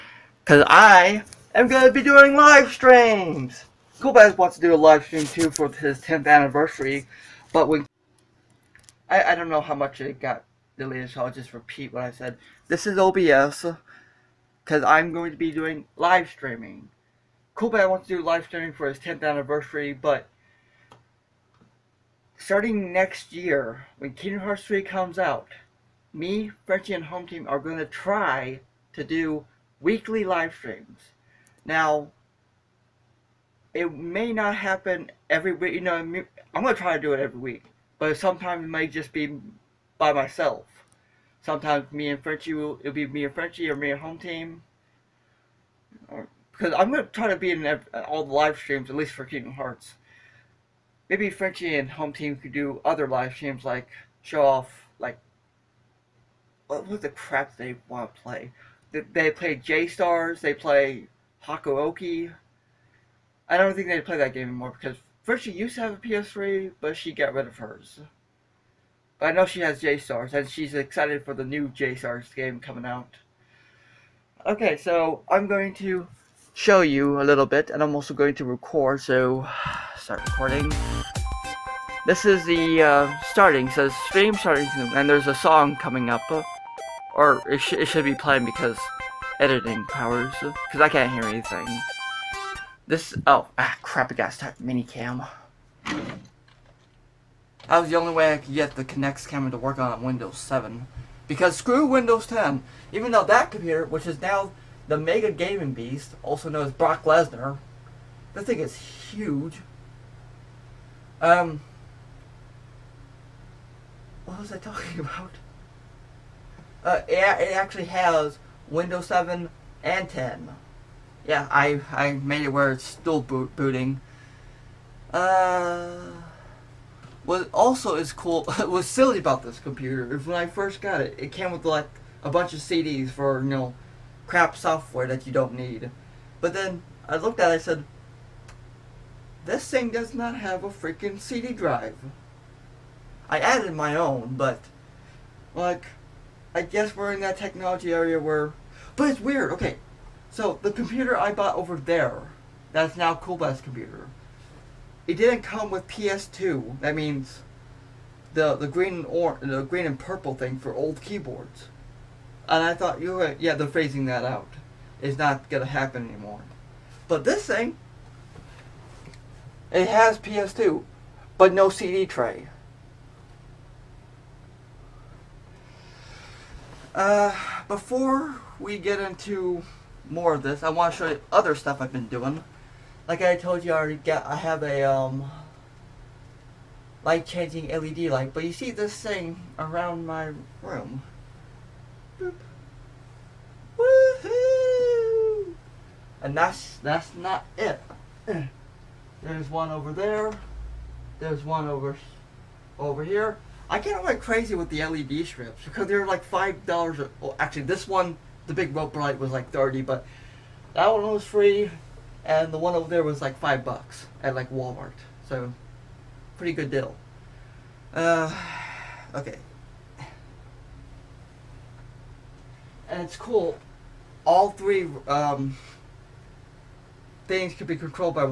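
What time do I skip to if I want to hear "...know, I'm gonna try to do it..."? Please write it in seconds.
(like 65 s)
35 s.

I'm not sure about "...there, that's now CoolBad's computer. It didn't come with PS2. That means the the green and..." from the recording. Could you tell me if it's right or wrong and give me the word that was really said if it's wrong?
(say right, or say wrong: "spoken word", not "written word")
right.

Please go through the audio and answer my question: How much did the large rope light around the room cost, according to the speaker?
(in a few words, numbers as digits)
$30.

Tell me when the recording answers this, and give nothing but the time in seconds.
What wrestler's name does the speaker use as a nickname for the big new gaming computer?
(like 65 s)
106 s.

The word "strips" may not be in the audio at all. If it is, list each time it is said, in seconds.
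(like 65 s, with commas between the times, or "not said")
205 s.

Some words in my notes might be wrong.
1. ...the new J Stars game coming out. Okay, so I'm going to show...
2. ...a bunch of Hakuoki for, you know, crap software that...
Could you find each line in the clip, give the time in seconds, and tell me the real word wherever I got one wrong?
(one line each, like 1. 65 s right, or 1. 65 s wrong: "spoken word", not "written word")
1. 71 s right
2. 132 s wrong: "CDs", not "Hakuoki".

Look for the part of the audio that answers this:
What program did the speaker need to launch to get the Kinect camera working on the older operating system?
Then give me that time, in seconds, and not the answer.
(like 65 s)
94 s.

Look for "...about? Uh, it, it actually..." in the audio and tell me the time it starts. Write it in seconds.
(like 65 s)
114 s.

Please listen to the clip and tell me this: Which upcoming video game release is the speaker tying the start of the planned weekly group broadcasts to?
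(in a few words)
Kingdom Hearts 3.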